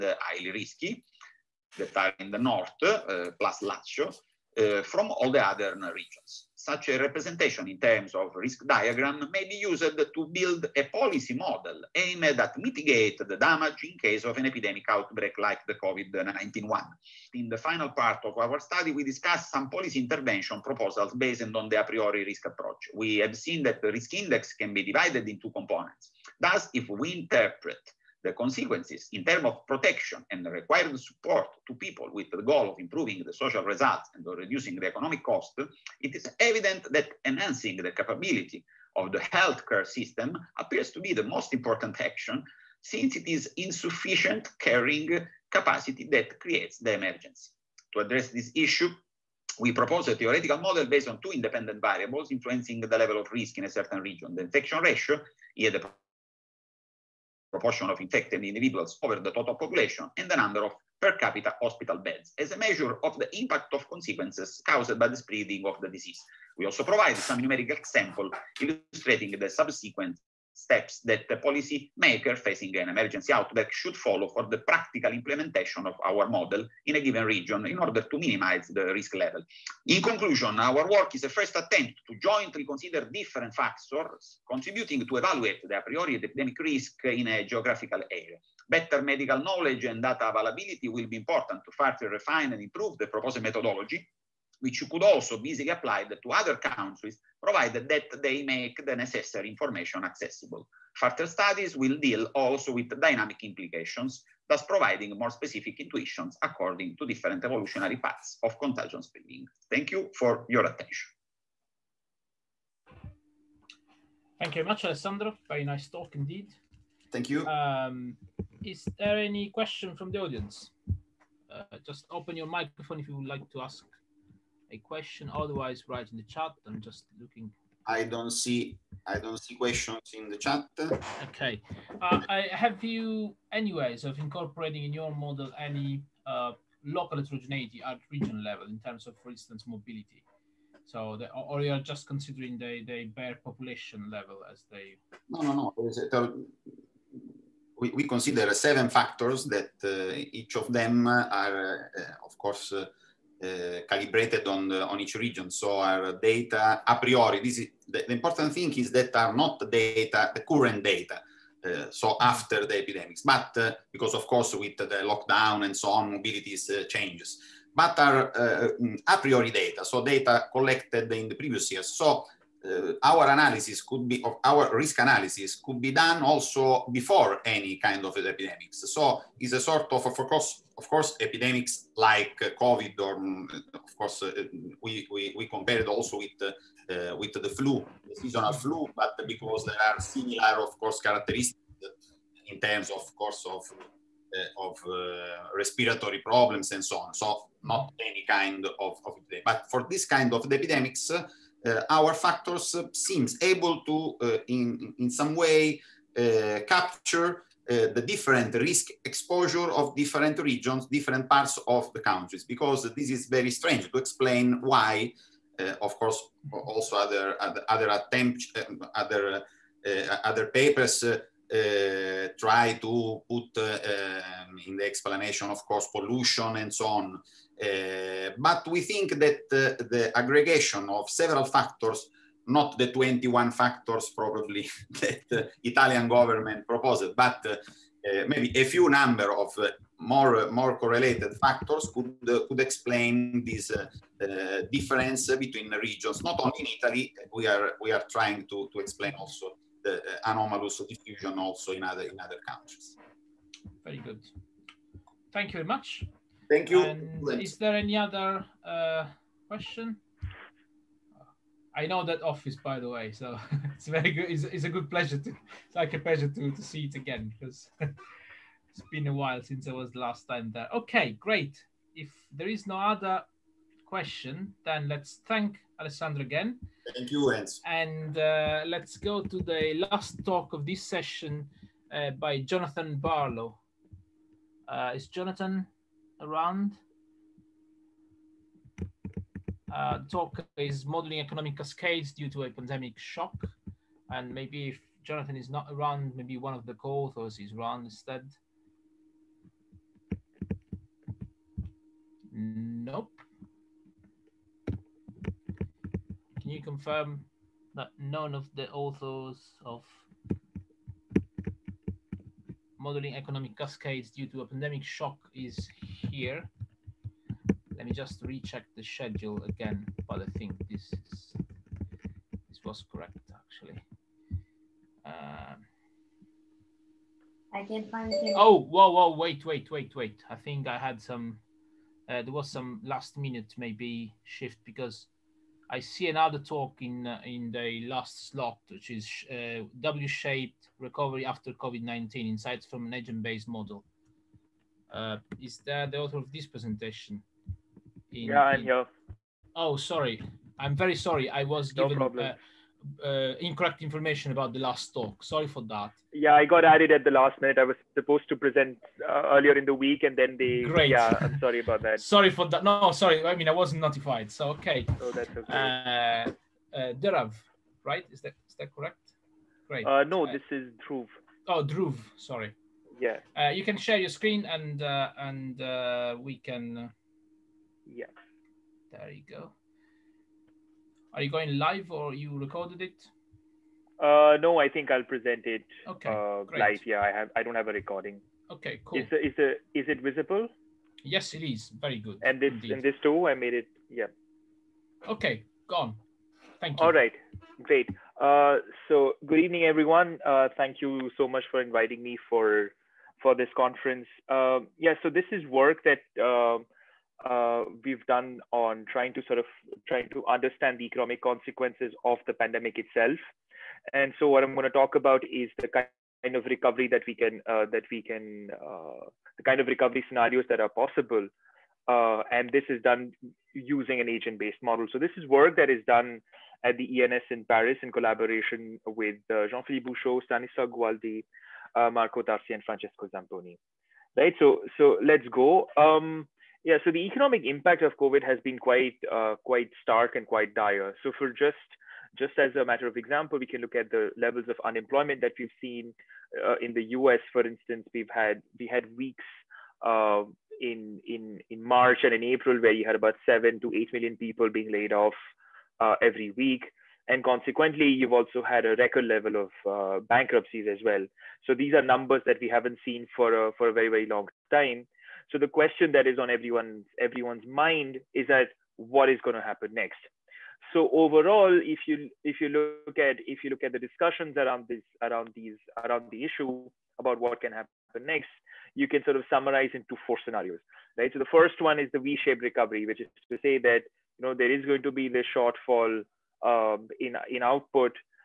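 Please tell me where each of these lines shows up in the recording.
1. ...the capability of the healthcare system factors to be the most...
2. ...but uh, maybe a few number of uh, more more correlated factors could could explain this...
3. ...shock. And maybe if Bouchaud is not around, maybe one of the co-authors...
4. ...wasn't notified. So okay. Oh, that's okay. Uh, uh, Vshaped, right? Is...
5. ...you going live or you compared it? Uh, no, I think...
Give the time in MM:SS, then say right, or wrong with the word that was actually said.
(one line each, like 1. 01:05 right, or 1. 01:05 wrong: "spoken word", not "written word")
1. 00:37 wrong: "appears", not "factors"
2. 03:57 right
3. 04:52 wrong: "Jonathan", not "Bouchaud"
4. 06:03 wrong: "Derav", not "Vshaped"
5. 06:21 wrong: "recorded", not "compared".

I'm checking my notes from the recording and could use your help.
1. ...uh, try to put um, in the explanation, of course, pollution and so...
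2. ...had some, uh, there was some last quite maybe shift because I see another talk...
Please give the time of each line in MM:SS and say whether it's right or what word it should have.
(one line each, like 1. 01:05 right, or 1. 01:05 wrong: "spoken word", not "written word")
1. 03:41 right
2. 05:30 wrong: "minute", not "quite".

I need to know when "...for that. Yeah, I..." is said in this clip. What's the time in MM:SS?
05:55.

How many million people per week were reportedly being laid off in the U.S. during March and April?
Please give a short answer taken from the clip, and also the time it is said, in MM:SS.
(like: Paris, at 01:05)
7 to 8 million, at 07:33.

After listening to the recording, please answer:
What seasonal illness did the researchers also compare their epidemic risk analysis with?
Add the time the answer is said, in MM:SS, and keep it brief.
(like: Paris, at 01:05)
seasonal flu, at 03:08.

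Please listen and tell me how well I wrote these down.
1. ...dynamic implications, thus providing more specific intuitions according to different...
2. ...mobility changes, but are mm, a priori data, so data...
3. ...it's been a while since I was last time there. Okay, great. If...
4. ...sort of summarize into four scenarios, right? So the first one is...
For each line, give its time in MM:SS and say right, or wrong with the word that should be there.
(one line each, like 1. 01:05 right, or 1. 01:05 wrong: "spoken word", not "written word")
1. 01:43 right
2. 02:46 right
3. 04:27 right
4. 07:59 right.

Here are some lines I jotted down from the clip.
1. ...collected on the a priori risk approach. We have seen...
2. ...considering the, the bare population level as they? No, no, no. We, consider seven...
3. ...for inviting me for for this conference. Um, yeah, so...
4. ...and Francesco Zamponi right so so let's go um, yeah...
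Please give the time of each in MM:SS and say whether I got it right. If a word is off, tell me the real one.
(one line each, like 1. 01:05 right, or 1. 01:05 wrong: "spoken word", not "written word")
1. 00:21 wrong: "based", not "collected"
2. 02:22 right
3. 06:41 right
4. 07:12 right.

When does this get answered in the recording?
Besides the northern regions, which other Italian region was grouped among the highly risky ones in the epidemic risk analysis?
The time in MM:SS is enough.
00:03.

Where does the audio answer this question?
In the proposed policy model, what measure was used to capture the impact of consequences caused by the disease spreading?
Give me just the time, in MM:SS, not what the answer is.
01:01.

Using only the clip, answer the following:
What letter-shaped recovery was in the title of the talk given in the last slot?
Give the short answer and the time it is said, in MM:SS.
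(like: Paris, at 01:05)
W-shaped, at 05:39.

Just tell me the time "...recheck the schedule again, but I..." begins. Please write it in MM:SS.
05:18.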